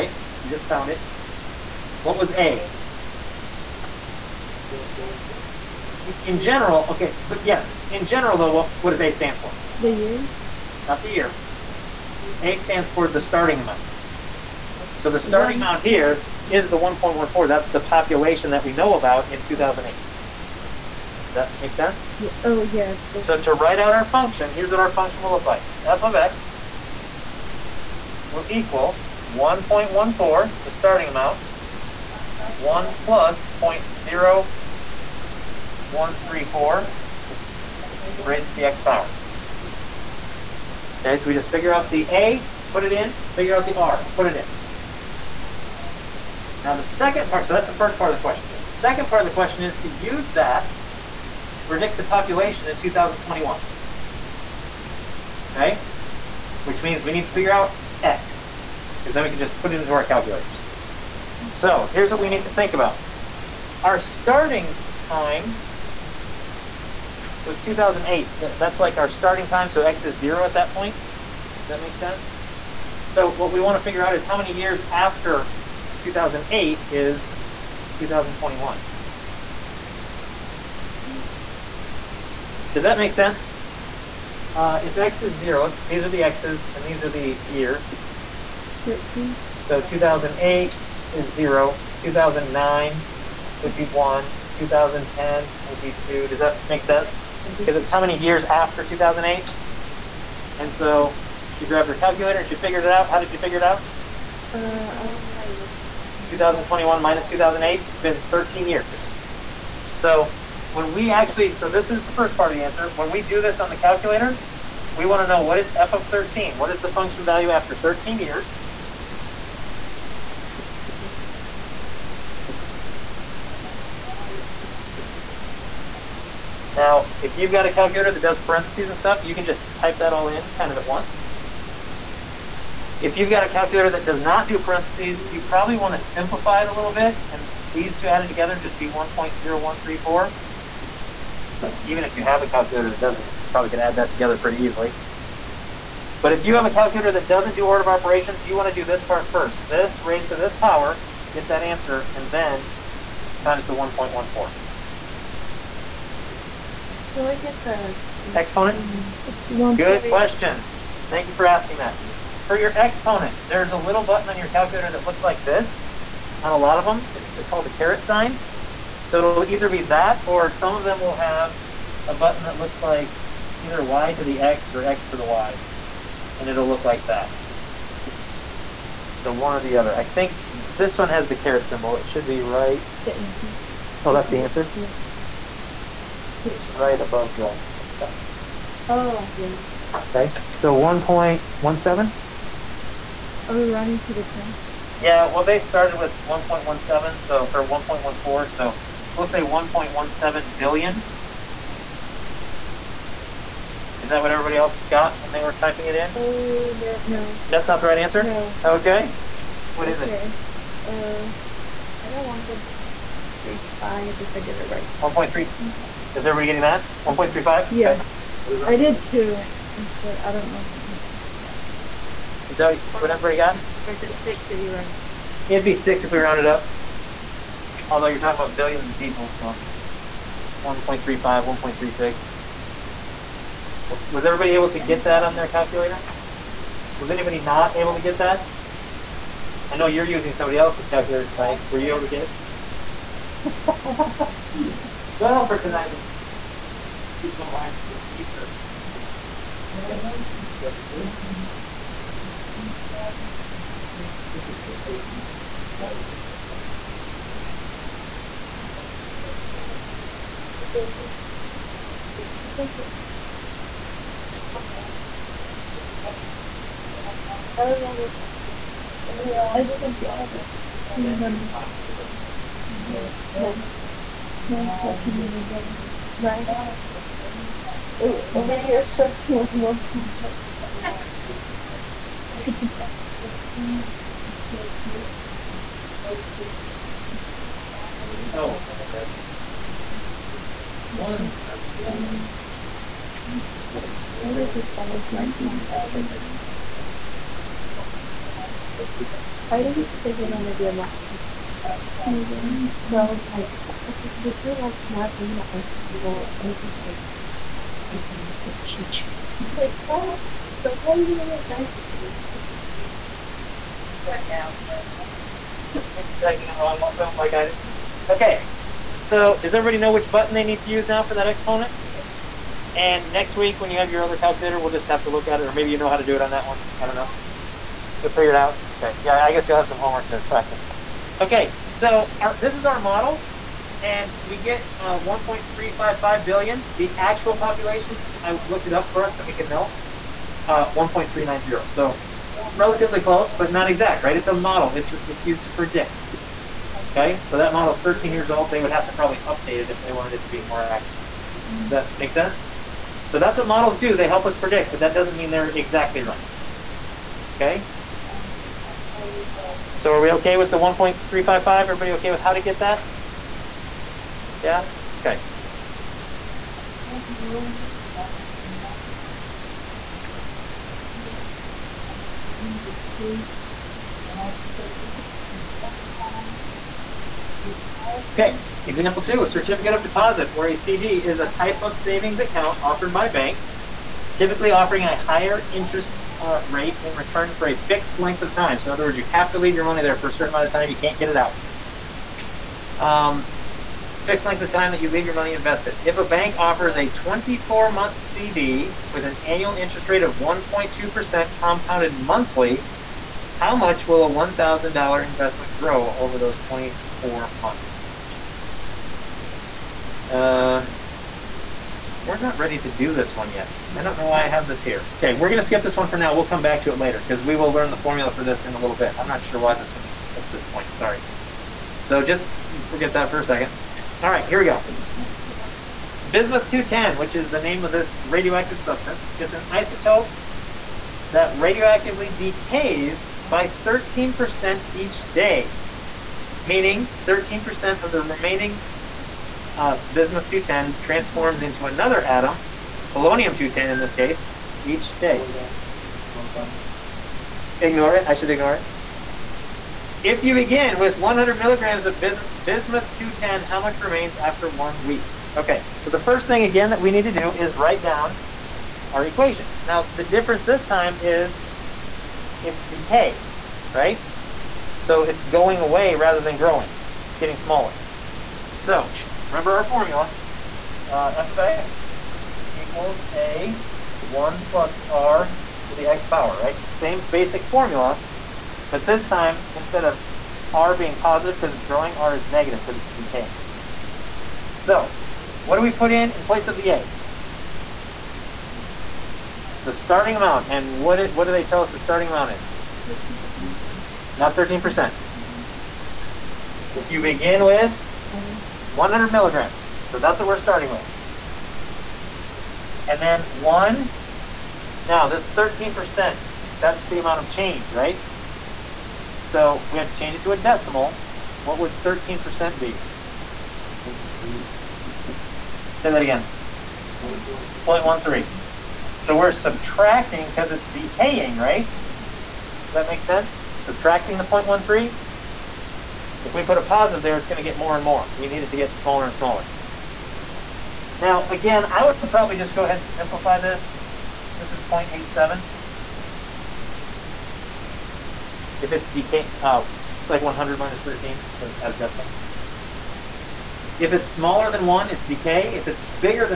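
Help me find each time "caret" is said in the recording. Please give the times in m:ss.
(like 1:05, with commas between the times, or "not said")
2:47, 3:01.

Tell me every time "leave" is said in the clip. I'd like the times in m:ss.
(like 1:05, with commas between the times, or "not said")
6:29, 6:34.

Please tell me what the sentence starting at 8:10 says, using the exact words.
And what, it, what do they tell us the starting amount is?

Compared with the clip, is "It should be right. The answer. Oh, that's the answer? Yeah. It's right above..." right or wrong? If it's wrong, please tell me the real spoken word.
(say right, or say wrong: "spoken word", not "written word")
right.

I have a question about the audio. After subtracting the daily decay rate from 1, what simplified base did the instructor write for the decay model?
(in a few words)
0.87.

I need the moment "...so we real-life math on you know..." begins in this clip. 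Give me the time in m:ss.
5:04.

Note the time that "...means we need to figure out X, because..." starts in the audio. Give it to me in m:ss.
0:56.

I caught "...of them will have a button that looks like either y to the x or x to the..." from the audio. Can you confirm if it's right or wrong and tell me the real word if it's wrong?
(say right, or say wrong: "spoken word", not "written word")
right.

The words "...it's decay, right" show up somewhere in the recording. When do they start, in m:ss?
7:42.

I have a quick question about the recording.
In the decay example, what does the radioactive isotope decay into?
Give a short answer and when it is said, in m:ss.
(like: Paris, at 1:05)
polonium 210, at 7:22.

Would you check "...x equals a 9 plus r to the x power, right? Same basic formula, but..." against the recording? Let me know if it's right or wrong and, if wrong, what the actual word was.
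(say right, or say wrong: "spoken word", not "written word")
wrong: "1", not "9".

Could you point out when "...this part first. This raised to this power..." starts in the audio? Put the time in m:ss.
2:28.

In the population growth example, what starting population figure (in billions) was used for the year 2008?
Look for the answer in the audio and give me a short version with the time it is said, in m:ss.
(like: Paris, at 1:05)
1.14, at 0:16.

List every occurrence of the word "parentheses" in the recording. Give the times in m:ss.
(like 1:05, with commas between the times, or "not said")
2:08, 2:14.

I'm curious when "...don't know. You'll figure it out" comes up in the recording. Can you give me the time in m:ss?
5:26.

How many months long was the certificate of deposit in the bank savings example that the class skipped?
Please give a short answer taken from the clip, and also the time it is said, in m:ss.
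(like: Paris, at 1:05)
24, at 6:36.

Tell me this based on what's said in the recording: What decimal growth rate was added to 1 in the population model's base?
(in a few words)
0.0134.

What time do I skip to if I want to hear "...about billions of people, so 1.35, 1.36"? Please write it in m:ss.
3:48.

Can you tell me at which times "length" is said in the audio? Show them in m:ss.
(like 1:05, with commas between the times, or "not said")
6:27, 6:34.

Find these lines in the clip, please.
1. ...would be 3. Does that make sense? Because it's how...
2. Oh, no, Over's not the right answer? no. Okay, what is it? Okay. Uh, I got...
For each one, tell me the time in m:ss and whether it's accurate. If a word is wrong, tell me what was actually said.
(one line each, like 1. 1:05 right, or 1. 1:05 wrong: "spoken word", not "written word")
1. 1:35 wrong: "2", not "3"
2. 3:26 wrong: "That", not "Over".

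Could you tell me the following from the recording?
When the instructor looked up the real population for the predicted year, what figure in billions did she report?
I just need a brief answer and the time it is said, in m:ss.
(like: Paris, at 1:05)
1.390, at 5:40.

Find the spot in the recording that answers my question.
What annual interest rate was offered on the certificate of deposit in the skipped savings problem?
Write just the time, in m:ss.
6:40.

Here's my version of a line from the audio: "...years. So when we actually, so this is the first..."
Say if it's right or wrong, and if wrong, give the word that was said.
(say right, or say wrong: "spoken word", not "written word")
right.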